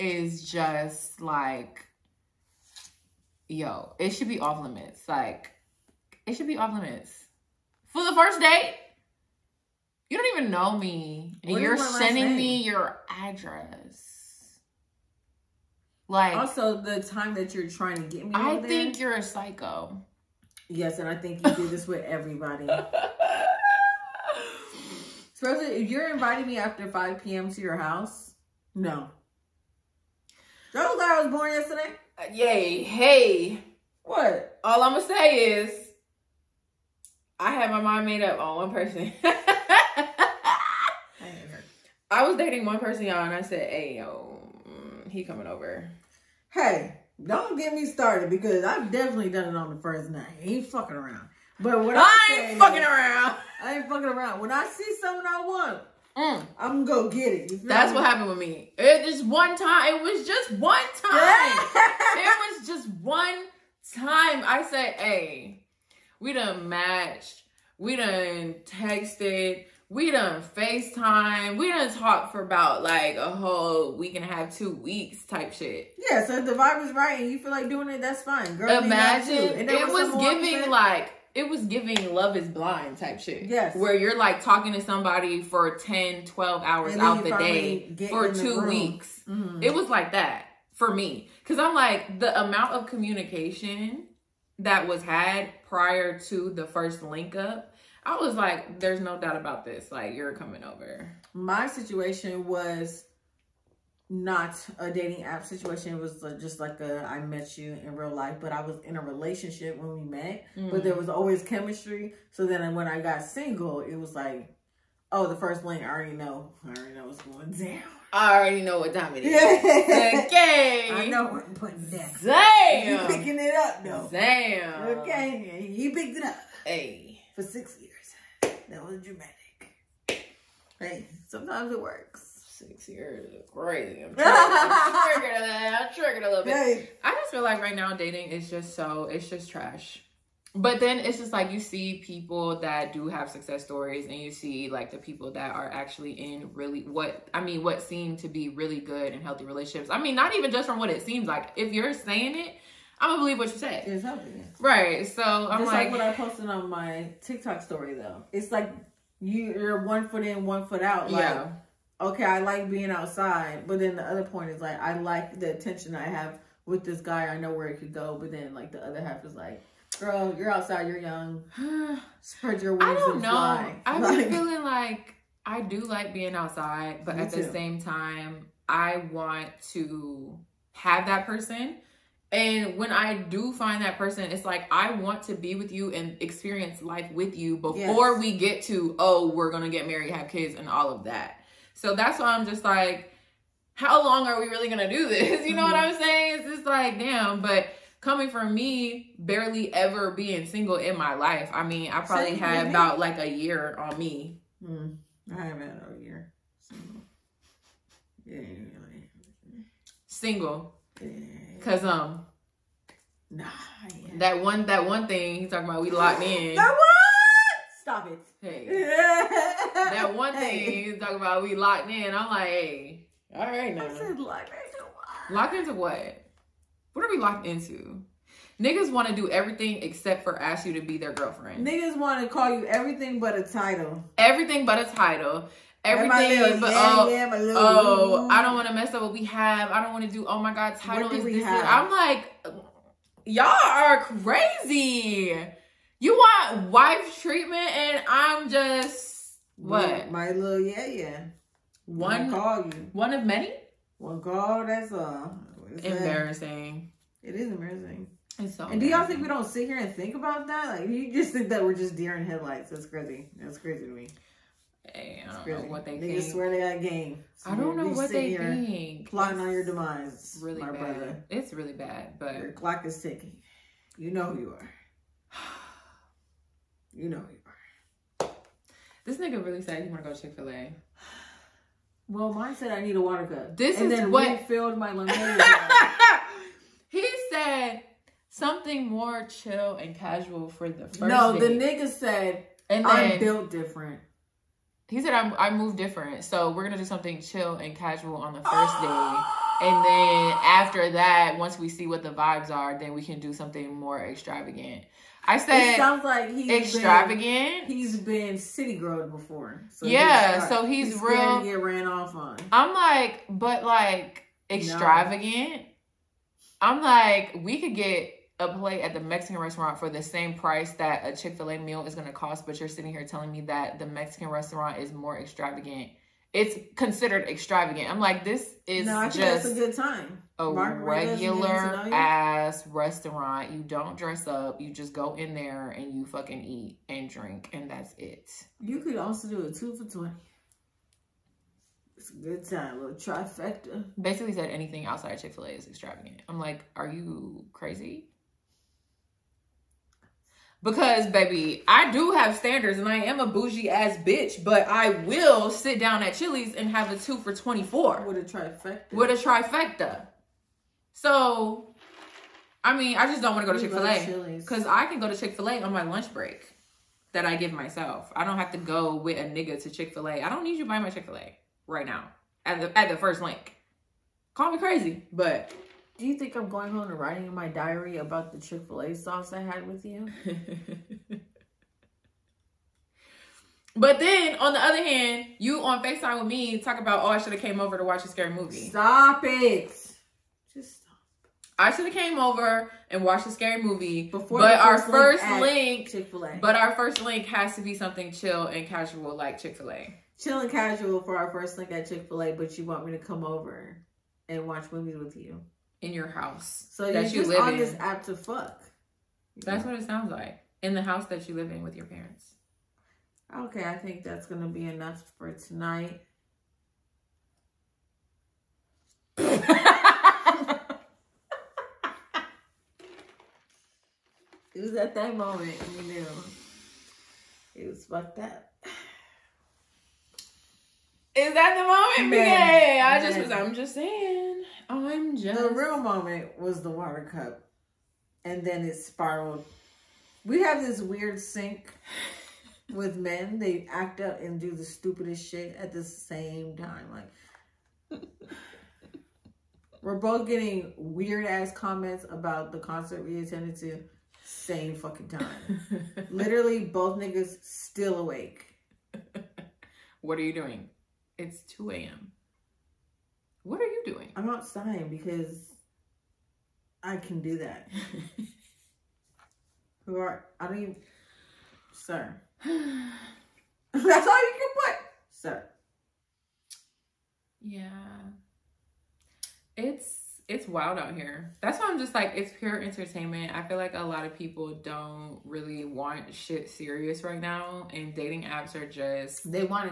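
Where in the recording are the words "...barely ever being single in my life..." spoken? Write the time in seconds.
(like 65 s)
199 s.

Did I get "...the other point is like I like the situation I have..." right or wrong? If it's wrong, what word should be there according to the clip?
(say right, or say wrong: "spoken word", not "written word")
wrong: "attention", not "situation".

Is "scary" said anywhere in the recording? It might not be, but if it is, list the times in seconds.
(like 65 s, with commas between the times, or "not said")
388 s, 393 s.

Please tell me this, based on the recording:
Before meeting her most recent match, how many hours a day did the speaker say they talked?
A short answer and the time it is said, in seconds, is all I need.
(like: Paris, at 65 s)
10 to 12 hours, at 85 s.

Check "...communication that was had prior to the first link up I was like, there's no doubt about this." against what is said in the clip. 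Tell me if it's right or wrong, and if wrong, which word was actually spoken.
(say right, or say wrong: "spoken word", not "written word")
right.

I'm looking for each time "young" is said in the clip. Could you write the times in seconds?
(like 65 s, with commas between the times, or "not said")
170 s.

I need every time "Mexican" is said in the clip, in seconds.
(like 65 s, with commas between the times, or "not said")
318 s, 323 s.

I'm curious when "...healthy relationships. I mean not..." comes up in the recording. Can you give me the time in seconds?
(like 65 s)
149 s.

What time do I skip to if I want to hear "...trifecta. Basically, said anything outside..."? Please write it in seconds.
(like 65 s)
342 s.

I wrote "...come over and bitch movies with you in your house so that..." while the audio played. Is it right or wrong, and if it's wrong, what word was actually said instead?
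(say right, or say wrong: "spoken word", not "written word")
wrong: "watch", not "bitch".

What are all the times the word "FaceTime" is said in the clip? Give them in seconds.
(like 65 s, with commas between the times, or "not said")
70 s, 385 s.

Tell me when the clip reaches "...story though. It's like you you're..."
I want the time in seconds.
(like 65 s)
157 s.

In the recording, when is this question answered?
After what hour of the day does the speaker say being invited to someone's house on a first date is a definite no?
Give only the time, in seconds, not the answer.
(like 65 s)
26 s.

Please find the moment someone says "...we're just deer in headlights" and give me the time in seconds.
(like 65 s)
261 s.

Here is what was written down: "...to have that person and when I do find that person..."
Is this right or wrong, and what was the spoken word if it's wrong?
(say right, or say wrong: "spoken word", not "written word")
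right.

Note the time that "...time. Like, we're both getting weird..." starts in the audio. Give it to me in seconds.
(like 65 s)
446 s.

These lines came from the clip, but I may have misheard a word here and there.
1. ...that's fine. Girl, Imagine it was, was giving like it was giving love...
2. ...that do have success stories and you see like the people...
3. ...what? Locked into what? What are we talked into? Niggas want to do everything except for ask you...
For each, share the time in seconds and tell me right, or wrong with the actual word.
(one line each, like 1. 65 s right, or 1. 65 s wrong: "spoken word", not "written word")
1. 78 s right
2. 142 s right
3. 224 s wrong: "locked", not "talked".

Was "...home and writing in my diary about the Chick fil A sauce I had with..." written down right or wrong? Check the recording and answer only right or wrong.
right.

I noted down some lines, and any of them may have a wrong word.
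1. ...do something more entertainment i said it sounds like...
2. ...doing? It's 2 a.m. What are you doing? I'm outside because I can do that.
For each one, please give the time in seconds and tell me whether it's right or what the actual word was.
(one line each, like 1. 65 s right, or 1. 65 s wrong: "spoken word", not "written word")
1. 303 s wrong: "extravagant", not "entertainment"
2. 460 s right.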